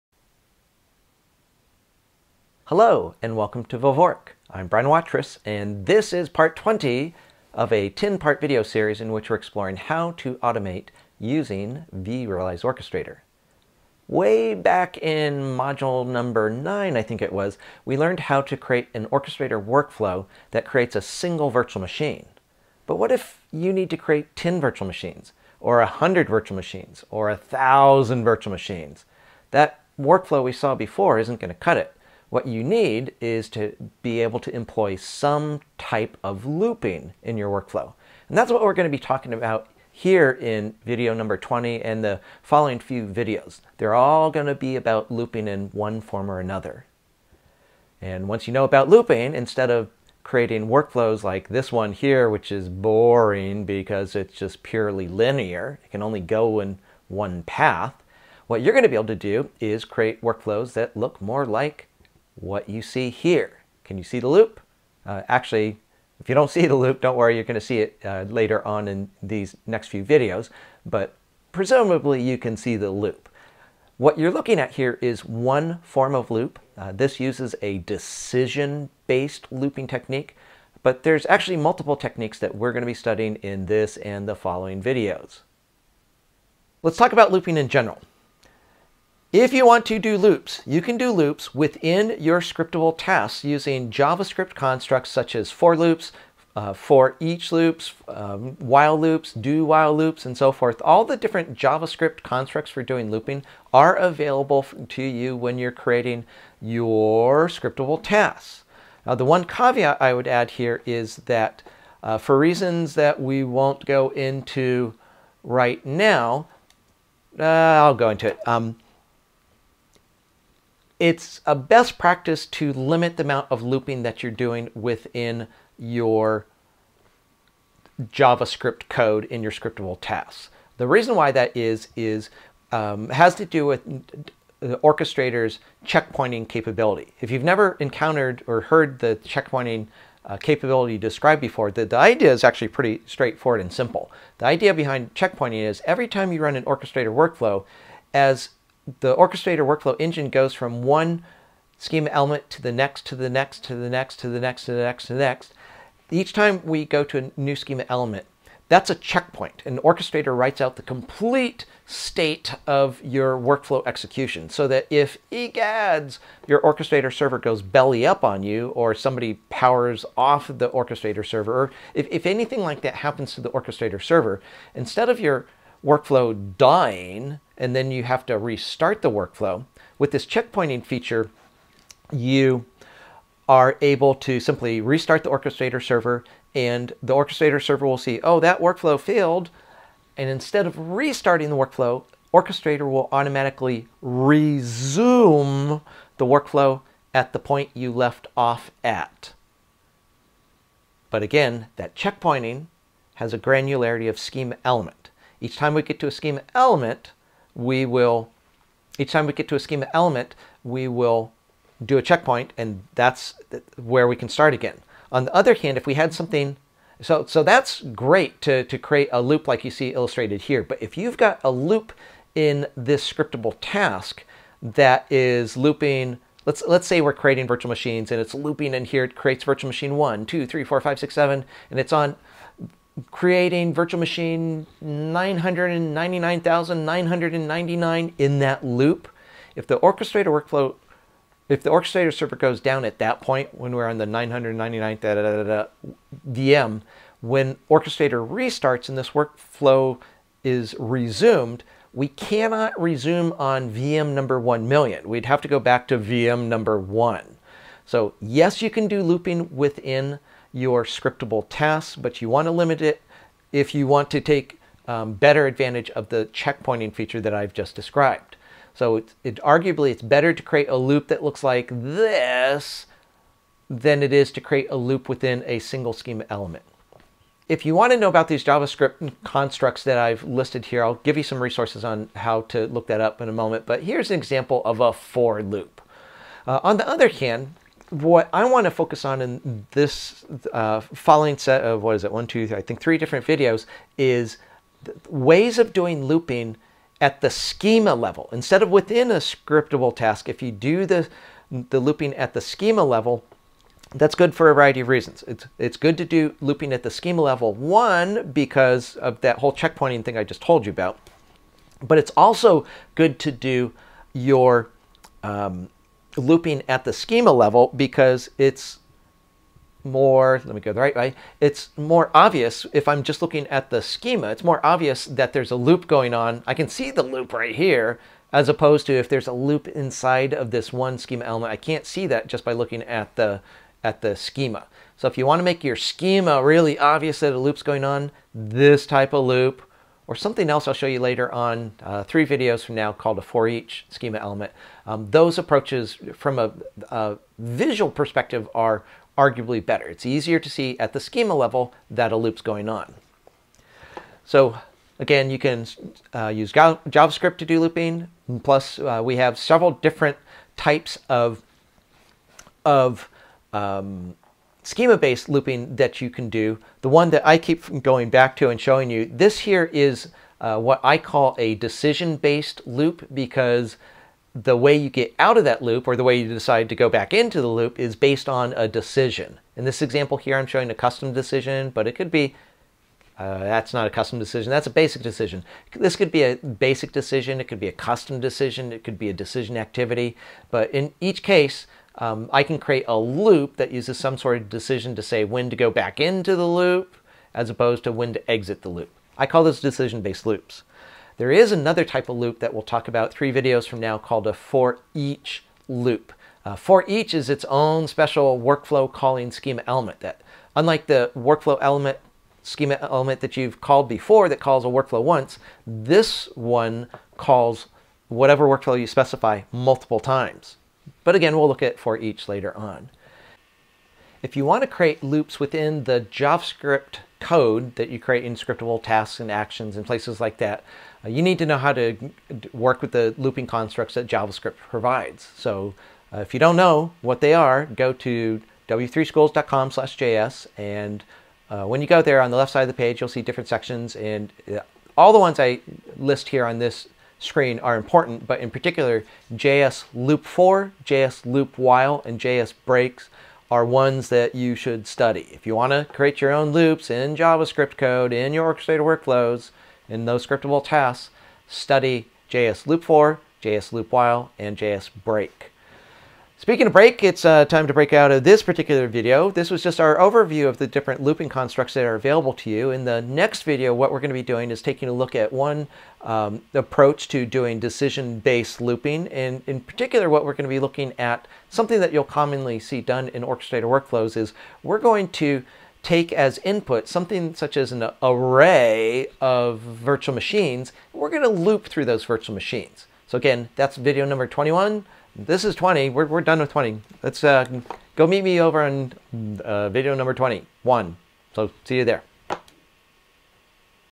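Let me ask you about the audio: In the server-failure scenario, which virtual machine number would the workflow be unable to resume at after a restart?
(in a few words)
1 million.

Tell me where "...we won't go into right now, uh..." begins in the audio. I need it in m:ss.
1:53.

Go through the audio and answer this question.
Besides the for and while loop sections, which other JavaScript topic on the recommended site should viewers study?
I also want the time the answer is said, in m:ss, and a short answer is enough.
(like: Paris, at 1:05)
JS break, at 7:32.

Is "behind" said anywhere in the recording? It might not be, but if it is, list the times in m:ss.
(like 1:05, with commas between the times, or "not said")
2:24.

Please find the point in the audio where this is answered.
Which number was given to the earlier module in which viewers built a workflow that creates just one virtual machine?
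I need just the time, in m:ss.
0:15.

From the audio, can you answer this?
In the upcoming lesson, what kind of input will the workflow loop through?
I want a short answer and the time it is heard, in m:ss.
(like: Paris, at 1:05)
array of virtual machines, at 8:08.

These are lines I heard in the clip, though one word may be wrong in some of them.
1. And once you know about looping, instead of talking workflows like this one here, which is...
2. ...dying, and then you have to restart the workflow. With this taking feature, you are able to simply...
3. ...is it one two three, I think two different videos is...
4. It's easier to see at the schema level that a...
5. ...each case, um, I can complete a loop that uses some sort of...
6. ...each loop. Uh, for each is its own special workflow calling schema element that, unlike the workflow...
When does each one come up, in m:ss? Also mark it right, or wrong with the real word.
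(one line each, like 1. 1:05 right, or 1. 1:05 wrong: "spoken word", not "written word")
1. 0:48 wrong: "creating", not "talking"
2. 2:56 wrong: "checkpointing", not "taking"
3. 4:51 wrong: "three", not "two"
4. 5:49 right
5. 6:31 wrong: "create", not "complete"
6. 6:44 right.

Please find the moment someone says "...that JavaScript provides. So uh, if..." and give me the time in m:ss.
7:13.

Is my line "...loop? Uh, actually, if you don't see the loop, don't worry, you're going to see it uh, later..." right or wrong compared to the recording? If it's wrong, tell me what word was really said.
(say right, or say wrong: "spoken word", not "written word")
right.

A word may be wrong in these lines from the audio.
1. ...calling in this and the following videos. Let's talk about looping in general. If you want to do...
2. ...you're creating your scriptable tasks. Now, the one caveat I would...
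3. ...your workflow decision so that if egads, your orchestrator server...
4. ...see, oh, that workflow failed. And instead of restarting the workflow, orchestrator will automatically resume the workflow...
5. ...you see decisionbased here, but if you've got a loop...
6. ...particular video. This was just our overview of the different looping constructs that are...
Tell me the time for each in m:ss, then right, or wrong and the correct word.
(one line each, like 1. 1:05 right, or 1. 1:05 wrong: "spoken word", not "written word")
1. 1:22 wrong: "studying", not "calling"
2. 1:45 right
3. 2:43 wrong: "execution", not "decision"
4. 3:07 right
5. 3:39 wrong: "illustrated", not "decisionbased"
6. 7:48 right.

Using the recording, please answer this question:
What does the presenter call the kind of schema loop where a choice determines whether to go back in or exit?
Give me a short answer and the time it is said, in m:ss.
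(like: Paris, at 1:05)
decision-based loop, at 6:11.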